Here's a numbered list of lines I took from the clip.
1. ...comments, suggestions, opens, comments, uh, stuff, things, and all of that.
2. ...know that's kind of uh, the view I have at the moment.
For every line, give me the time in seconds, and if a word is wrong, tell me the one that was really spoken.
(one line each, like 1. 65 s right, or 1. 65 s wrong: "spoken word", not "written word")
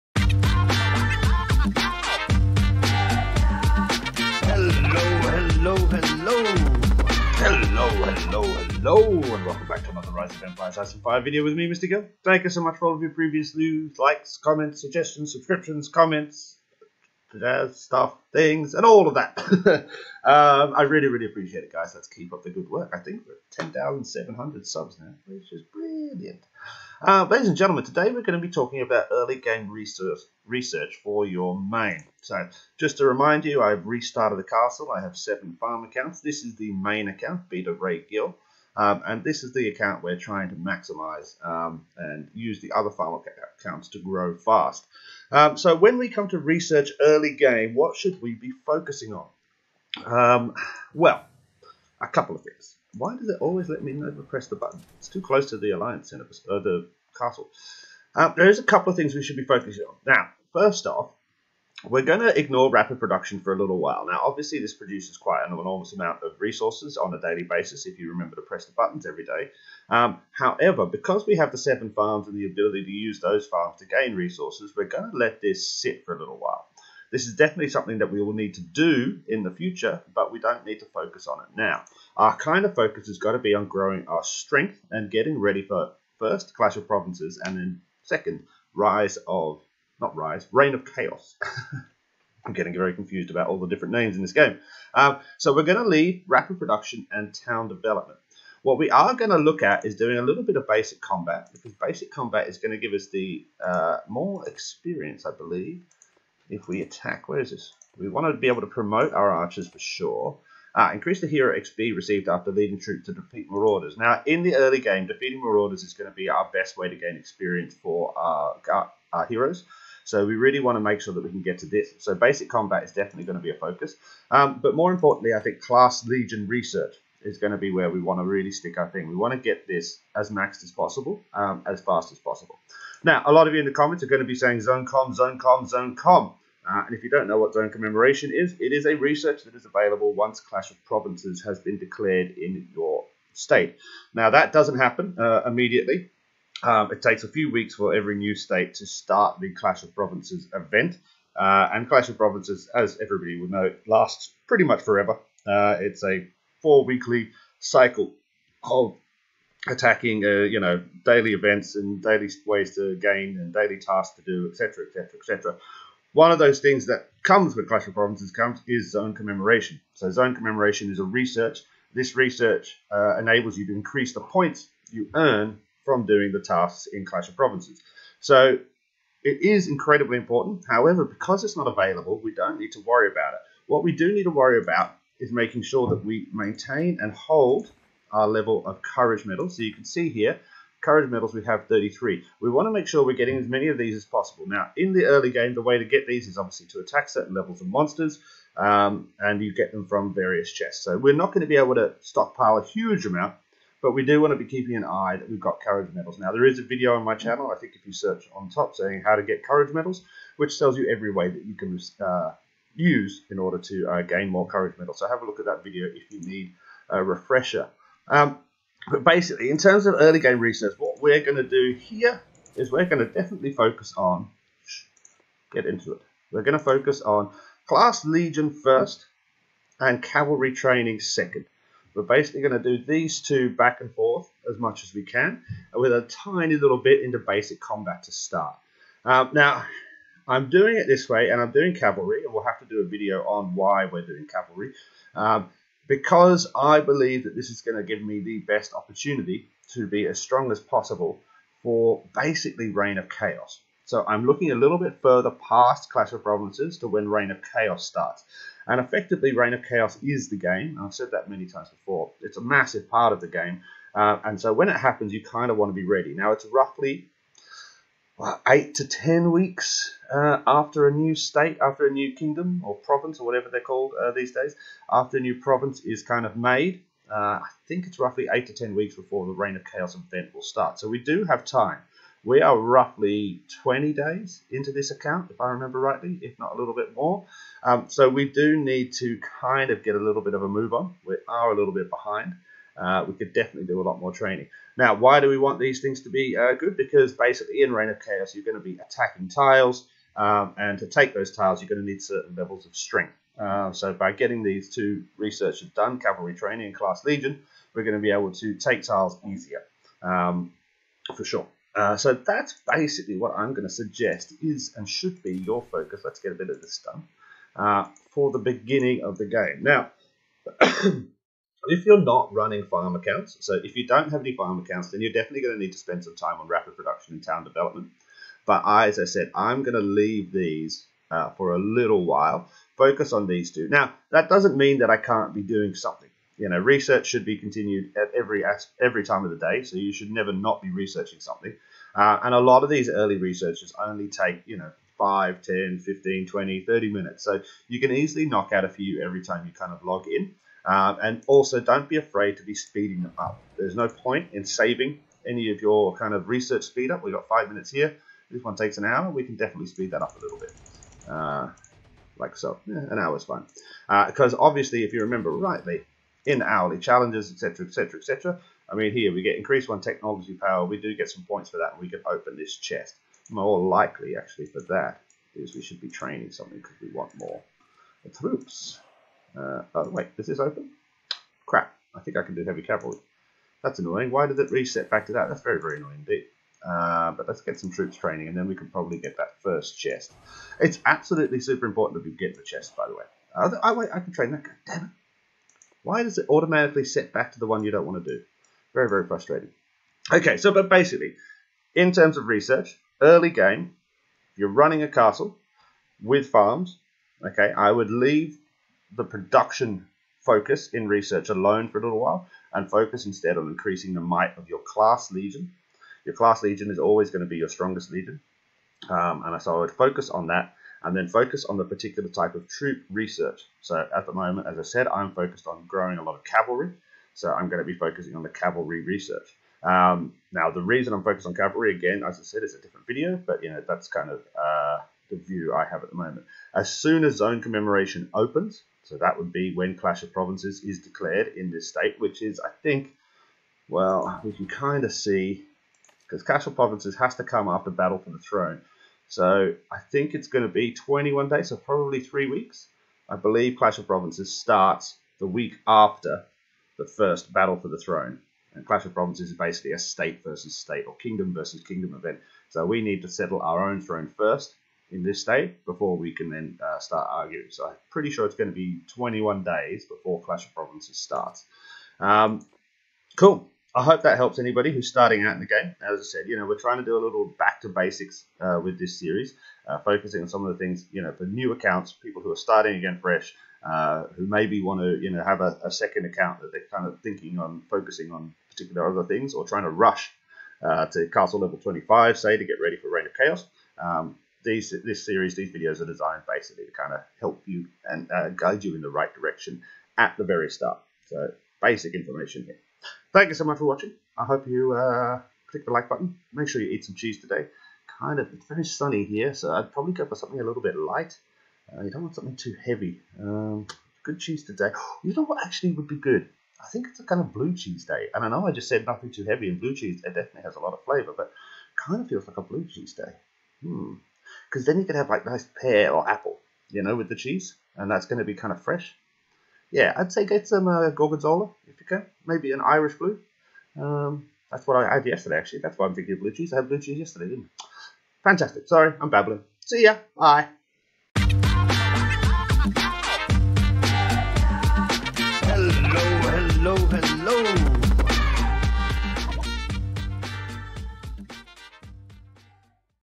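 1. 14 s wrong: "subscriptions", not "opens"
2. 433 s right.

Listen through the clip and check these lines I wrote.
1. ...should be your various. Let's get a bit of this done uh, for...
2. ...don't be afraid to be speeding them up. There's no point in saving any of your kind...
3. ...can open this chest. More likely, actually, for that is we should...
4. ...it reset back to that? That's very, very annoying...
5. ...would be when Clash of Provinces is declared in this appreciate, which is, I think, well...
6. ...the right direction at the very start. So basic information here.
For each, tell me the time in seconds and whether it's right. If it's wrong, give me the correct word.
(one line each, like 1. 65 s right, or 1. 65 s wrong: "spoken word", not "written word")
1. 314 s wrong: "focus", not "various"
2. 351 s right
3. 371 s right
4. 384 s right
5. 439 s wrong: "state", not "appreciate"
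6. 498 s right.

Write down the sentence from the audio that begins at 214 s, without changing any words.
So have a look at that video if you need a refresher.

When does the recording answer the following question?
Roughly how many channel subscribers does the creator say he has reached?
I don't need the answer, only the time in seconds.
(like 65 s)
23 s.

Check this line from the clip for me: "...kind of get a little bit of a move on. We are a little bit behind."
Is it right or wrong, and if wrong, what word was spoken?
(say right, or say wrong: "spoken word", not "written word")
right.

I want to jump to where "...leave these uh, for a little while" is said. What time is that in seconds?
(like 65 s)
329 s.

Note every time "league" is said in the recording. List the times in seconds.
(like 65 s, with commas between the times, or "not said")
not said.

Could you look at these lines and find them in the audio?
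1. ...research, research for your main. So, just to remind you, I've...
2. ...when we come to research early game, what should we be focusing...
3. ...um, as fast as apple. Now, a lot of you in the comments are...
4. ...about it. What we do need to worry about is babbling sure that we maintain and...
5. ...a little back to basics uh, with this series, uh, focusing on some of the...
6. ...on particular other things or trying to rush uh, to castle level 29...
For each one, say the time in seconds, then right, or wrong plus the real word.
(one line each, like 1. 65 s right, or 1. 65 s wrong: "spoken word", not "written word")
1. 29 s right
2. 45 s right
3. 131 s wrong: "possible", not "apple"
4. 183 s wrong: "making", not "babbling"
5. 476 s right
6. 488 s wrong: "25", not "29".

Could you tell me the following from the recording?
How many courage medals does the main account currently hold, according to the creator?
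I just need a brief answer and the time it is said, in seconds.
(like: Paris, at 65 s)
33, at 191 s.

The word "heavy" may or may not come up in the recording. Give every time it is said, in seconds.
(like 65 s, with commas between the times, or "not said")
382 s, 512 s, 519 s.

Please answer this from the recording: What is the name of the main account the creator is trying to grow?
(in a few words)
Beta Ray Gill.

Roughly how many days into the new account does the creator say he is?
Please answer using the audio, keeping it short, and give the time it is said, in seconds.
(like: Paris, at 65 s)
20, at 283 s.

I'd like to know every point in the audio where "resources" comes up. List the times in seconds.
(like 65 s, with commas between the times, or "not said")
66 s, 74 s.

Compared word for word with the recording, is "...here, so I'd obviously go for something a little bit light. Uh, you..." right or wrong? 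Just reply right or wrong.
wrong.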